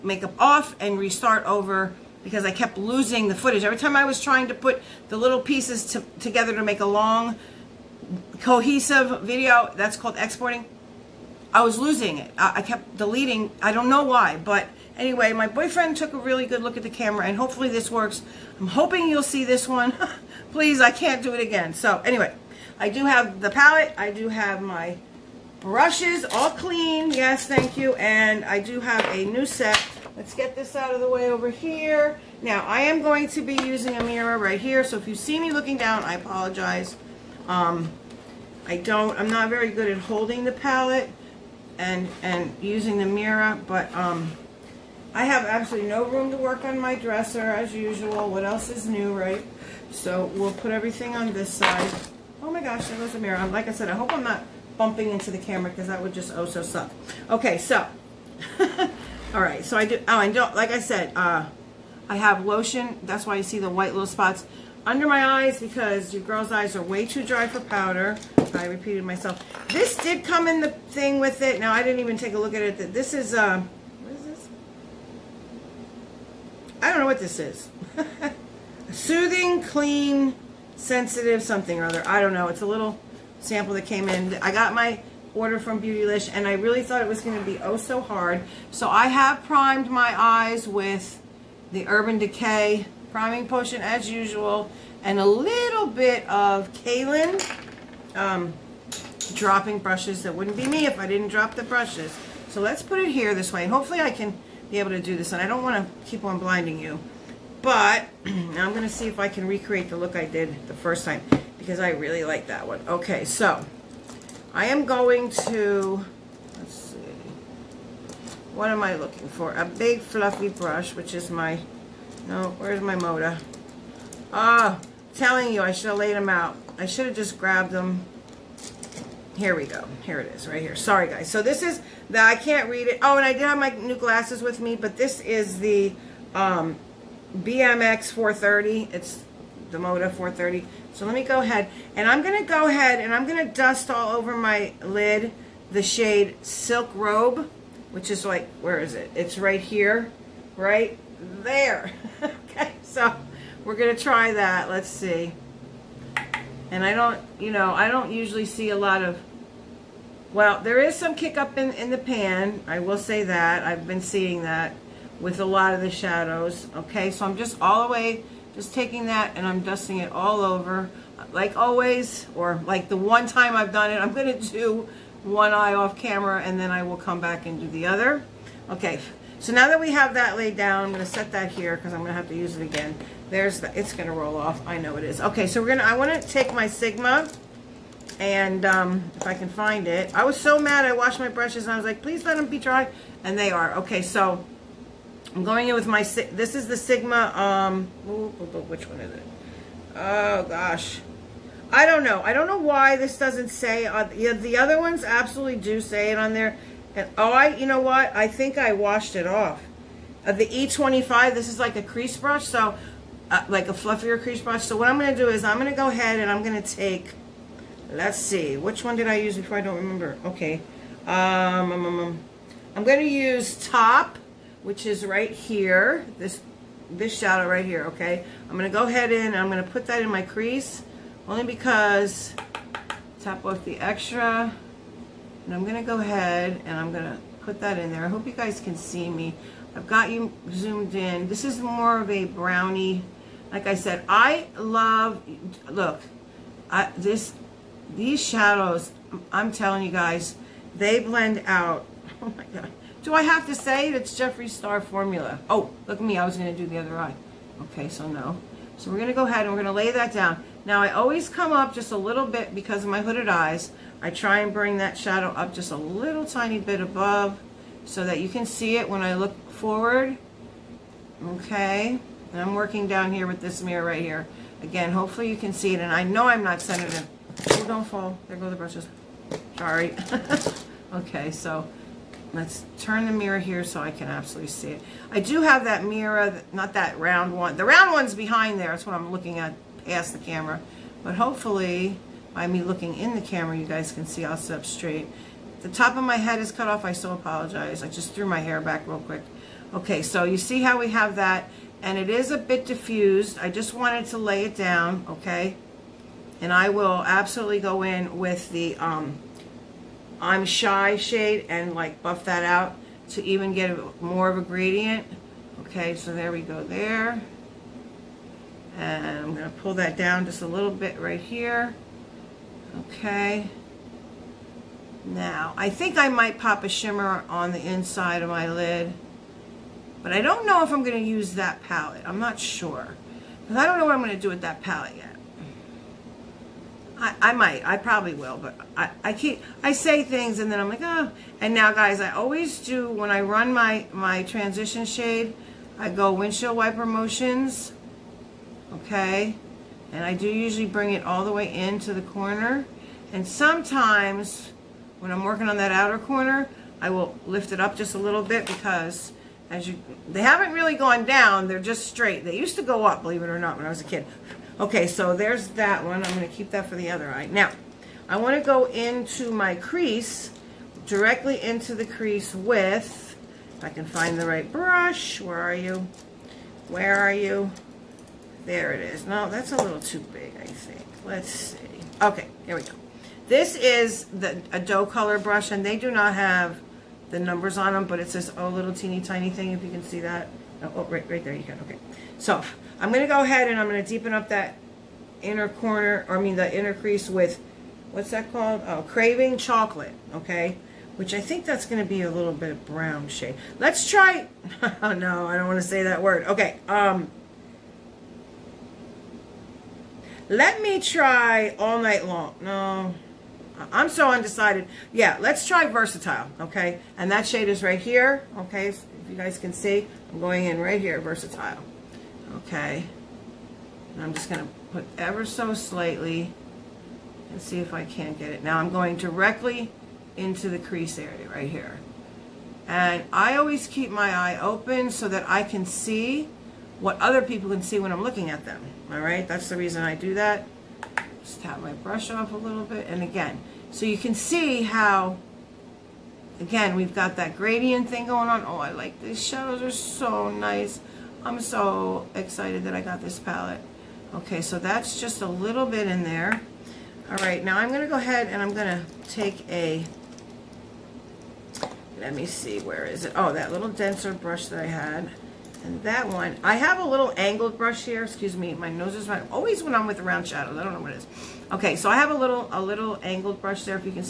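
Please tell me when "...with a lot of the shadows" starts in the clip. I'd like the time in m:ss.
2:45.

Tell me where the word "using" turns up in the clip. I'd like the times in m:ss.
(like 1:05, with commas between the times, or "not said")
0:33, 0:42.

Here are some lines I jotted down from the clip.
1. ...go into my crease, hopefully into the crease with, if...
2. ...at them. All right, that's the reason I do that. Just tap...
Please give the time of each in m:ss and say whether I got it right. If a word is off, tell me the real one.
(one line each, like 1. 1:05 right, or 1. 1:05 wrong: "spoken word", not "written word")
1. 6:08 wrong: "directly", not "hopefully"
2. 7:18 right.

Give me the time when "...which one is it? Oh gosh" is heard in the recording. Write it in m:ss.
3:17.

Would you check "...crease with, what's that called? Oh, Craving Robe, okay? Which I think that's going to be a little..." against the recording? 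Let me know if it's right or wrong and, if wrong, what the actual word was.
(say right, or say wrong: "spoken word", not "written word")
wrong: "Chocolate", not "Robe".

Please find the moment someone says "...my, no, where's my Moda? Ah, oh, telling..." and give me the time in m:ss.
2:01.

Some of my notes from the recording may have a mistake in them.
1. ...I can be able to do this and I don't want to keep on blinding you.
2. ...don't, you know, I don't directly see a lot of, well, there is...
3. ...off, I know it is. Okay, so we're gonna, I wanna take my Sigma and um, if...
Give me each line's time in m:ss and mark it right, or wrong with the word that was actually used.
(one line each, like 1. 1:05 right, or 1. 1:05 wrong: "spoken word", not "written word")
1. 1:44 right
2. 2:36 wrong: "usually", not "directly"
3. 3:04 right.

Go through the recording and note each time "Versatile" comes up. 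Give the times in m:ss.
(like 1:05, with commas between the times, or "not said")
6:55, 7:01.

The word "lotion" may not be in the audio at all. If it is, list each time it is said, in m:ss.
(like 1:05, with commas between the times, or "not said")
1:02.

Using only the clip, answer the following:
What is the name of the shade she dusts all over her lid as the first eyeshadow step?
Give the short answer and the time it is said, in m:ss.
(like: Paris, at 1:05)
Silk Robe, at 2:26.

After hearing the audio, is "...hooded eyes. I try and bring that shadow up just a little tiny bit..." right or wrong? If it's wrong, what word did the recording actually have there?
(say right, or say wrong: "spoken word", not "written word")
right.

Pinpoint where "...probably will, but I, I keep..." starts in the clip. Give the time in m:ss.
5:37.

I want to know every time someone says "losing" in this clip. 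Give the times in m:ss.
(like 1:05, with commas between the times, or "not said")
0:02, 0:11.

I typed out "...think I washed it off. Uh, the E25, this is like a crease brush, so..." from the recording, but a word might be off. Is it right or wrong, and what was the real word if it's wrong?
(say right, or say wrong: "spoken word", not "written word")
right.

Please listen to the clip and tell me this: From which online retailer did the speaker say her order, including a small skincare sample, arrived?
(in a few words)
Beautylish.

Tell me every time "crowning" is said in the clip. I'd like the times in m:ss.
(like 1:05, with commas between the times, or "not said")
not said.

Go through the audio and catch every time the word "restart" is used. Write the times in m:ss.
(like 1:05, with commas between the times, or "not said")
0:00.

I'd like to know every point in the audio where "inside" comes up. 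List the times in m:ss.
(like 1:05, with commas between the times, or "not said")
5:27.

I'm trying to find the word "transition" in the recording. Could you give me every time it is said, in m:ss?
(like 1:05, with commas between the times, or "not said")
5:44.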